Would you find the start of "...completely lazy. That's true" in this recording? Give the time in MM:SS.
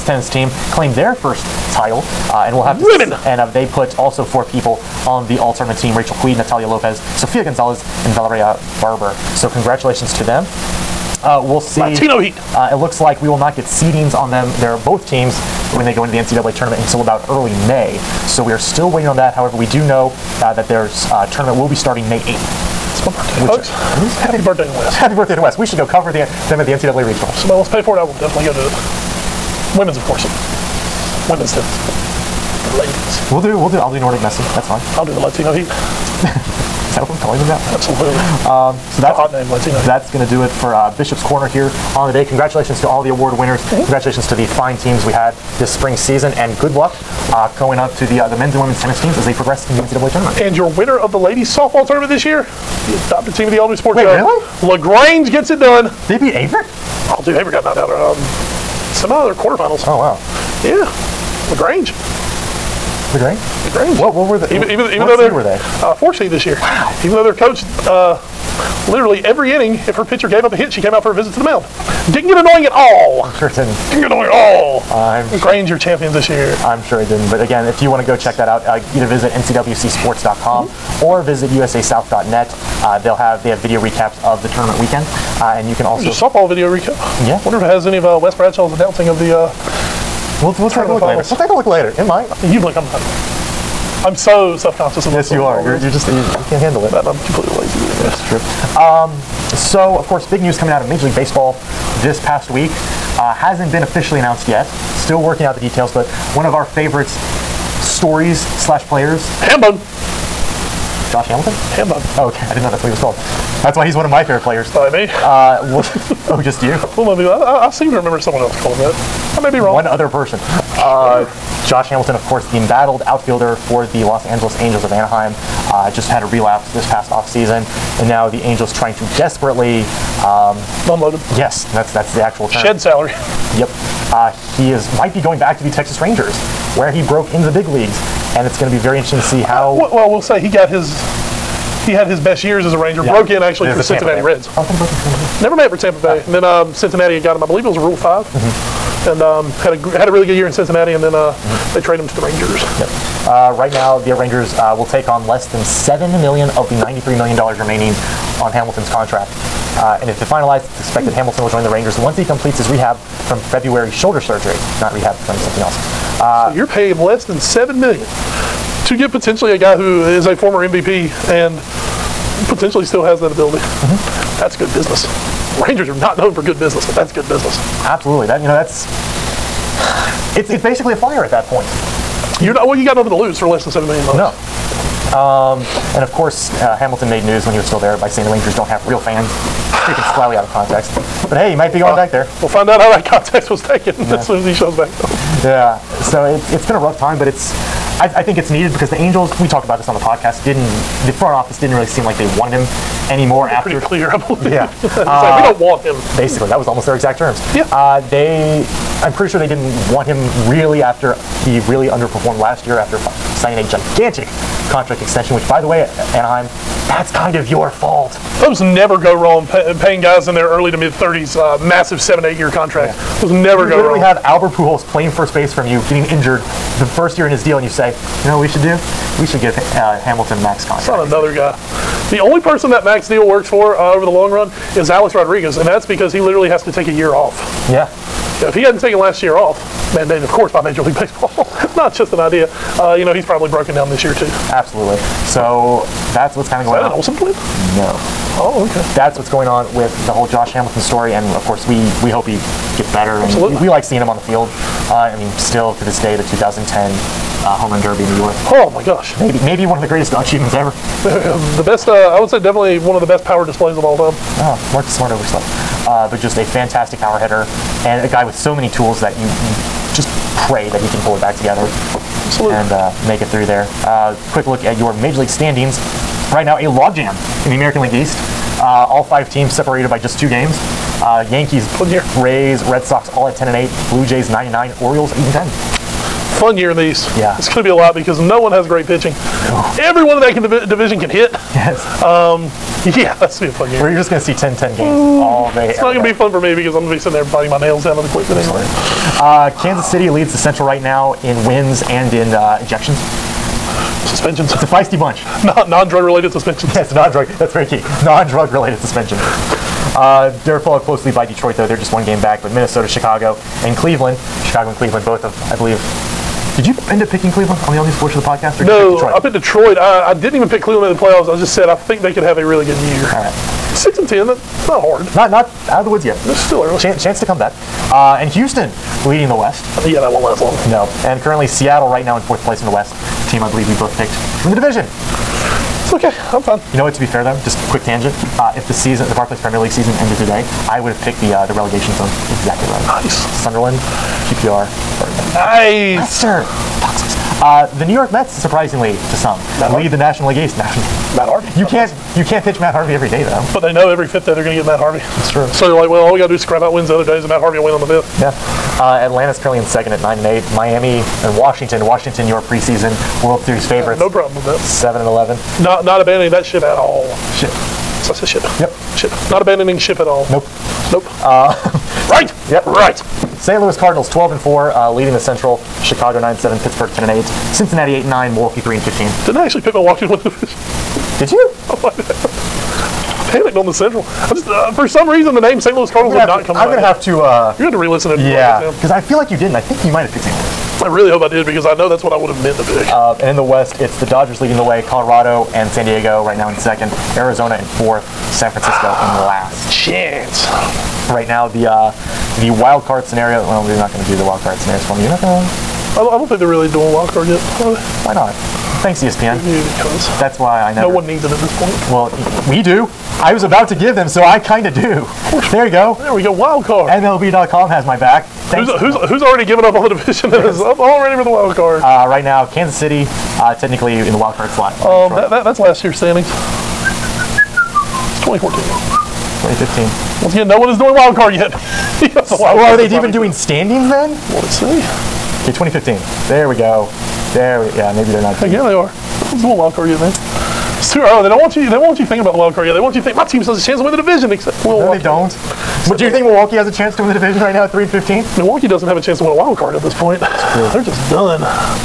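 01:37.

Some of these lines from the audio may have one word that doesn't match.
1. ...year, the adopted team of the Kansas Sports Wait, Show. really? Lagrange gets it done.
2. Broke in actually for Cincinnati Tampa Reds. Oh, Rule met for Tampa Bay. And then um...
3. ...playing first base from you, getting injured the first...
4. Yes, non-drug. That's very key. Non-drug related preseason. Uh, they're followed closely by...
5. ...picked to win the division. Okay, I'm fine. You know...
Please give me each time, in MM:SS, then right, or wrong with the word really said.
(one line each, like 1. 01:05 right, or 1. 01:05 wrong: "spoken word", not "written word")
1. 00:52 wrong: "Elder", not "Kansas"
2. 02:23 wrong: "Never", not "Rule"
3. 03:44 right
4. 05:06 wrong: "suspension", not "preseason"
5. 05:33 right.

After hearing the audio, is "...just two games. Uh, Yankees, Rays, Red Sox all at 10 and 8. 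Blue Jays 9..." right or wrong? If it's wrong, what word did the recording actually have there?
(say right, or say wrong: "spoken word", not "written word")
right.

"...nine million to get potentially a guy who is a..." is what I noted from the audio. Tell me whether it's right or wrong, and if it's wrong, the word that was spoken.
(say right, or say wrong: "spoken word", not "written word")
wrong: "seven", not "nine".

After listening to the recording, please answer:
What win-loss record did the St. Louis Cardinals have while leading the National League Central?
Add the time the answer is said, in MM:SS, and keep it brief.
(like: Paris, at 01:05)
12 and 4, at 06:14.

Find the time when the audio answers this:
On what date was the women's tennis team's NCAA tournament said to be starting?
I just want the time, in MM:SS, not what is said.
00:22.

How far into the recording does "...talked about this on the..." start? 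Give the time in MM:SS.
03:19.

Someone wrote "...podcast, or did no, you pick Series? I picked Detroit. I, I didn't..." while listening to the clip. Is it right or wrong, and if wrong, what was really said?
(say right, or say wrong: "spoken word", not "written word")
wrong: "Detroit", not "Series".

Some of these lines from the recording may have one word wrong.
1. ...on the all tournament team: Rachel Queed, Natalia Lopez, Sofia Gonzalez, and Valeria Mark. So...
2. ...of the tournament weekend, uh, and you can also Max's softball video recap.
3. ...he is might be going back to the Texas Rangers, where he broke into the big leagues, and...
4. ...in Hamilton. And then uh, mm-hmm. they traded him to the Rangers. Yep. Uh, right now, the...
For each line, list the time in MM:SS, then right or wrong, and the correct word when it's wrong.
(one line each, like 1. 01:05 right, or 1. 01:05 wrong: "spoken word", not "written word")
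1. 00:05 wrong: "Barber", not "Mark"
2. 01:24 wrong: "There", not "Max"
3. 02:14 right
4. 02:30 wrong: "Cincinnati", not "Hamilton".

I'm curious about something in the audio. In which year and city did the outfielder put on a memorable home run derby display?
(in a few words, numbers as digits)
2010, New York.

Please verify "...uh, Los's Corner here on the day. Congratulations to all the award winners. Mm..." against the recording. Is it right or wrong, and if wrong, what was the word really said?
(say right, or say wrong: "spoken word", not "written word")
wrong: "Bishop", not "Los".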